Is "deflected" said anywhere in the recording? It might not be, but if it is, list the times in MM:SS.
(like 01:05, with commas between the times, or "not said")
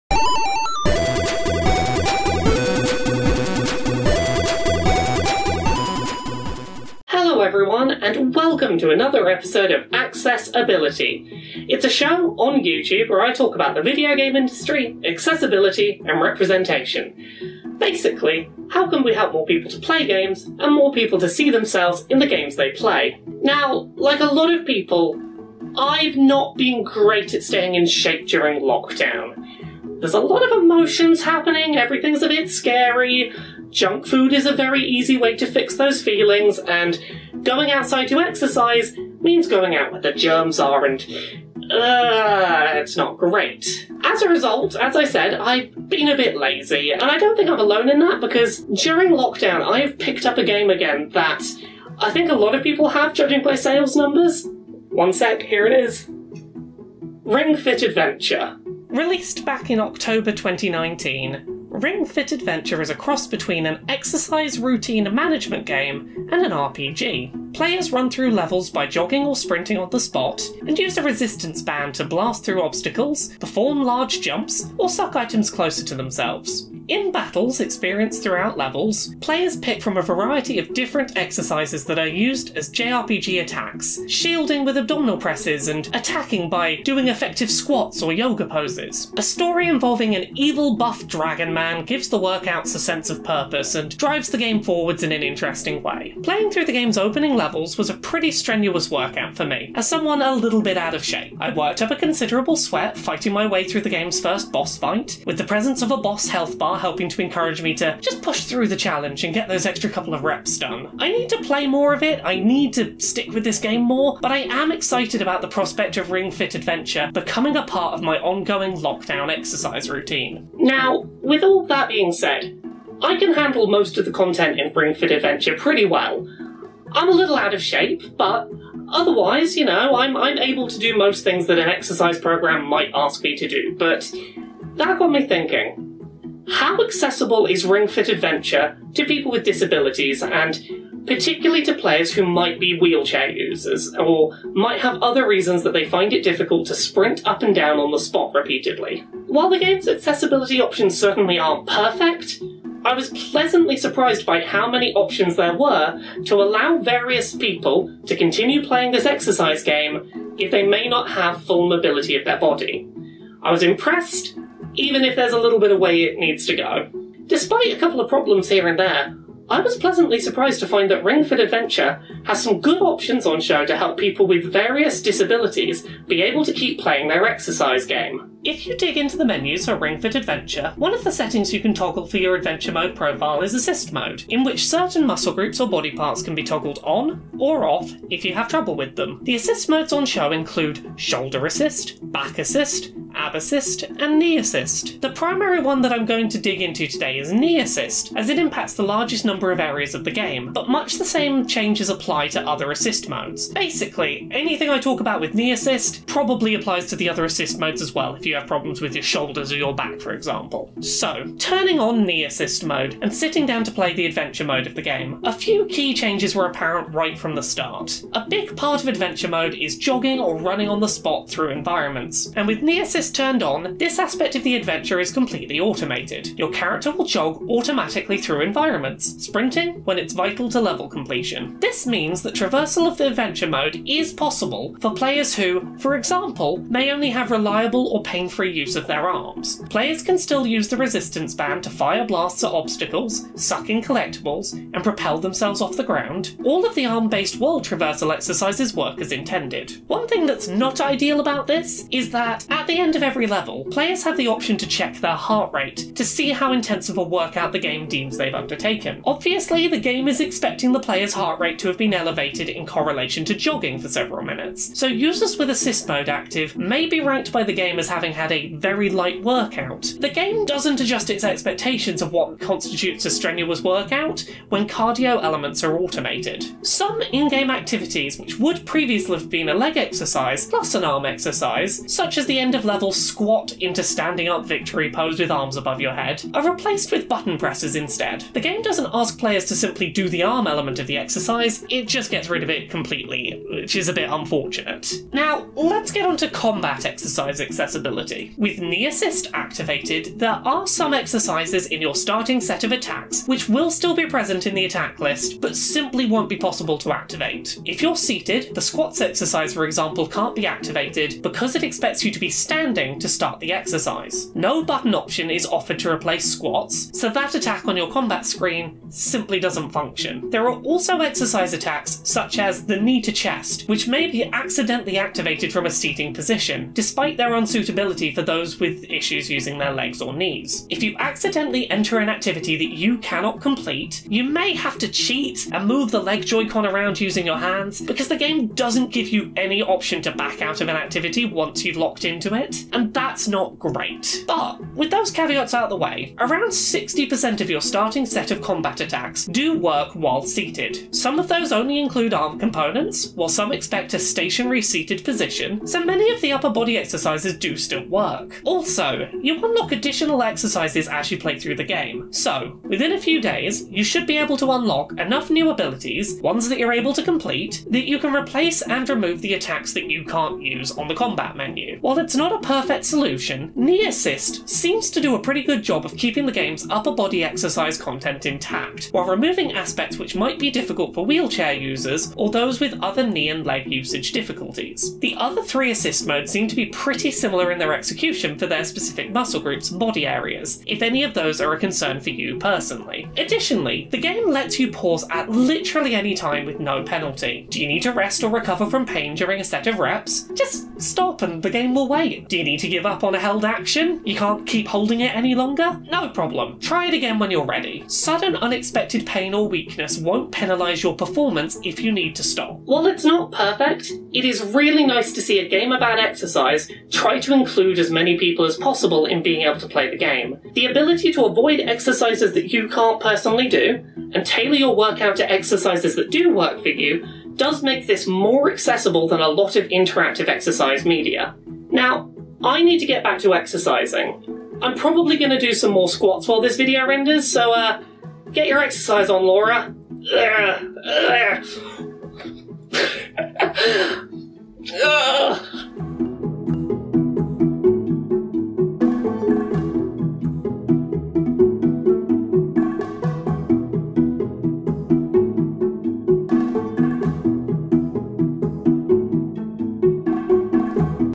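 not said.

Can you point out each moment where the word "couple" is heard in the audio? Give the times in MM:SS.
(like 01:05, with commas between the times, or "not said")
01:49, 02:47.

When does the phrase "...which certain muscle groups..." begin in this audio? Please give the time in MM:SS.
03:04.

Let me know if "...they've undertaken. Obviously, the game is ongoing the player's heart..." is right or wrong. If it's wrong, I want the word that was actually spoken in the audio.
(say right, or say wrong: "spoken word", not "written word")
wrong: "expecting", not "ongoing".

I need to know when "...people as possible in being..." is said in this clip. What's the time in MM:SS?
06:58.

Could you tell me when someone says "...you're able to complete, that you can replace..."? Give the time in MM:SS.
06:06.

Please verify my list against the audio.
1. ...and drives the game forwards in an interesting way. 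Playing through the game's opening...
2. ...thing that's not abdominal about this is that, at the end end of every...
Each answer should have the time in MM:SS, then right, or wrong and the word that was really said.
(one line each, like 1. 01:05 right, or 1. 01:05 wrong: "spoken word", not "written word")
1. 01:33 right
2. 04:10 wrong: "ideal", not "abdominal".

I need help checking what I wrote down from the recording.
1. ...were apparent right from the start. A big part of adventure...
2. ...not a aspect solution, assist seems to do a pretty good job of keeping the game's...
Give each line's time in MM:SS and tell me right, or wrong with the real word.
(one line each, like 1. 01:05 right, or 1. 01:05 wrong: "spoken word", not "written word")
1. 03:36 right
2. 06:12 wrong: "perfect", not "aspect".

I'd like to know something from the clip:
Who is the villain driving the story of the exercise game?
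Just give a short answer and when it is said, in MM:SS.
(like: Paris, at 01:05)
evil buff dragon man, at 01:30.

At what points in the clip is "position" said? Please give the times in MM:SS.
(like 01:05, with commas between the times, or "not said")
05:26, 05:55.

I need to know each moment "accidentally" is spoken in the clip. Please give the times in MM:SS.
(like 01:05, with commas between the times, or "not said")
05:24, 05:30.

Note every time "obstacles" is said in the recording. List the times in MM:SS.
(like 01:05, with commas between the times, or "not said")
01:12, 04:02.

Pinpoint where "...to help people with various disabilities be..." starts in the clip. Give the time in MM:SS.
02:53.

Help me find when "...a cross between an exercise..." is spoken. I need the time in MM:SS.
01:02.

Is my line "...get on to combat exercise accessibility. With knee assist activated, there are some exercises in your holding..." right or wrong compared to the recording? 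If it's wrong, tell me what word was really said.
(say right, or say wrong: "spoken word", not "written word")
wrong: "starting", not "holding".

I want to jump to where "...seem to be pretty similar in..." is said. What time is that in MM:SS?
06:26.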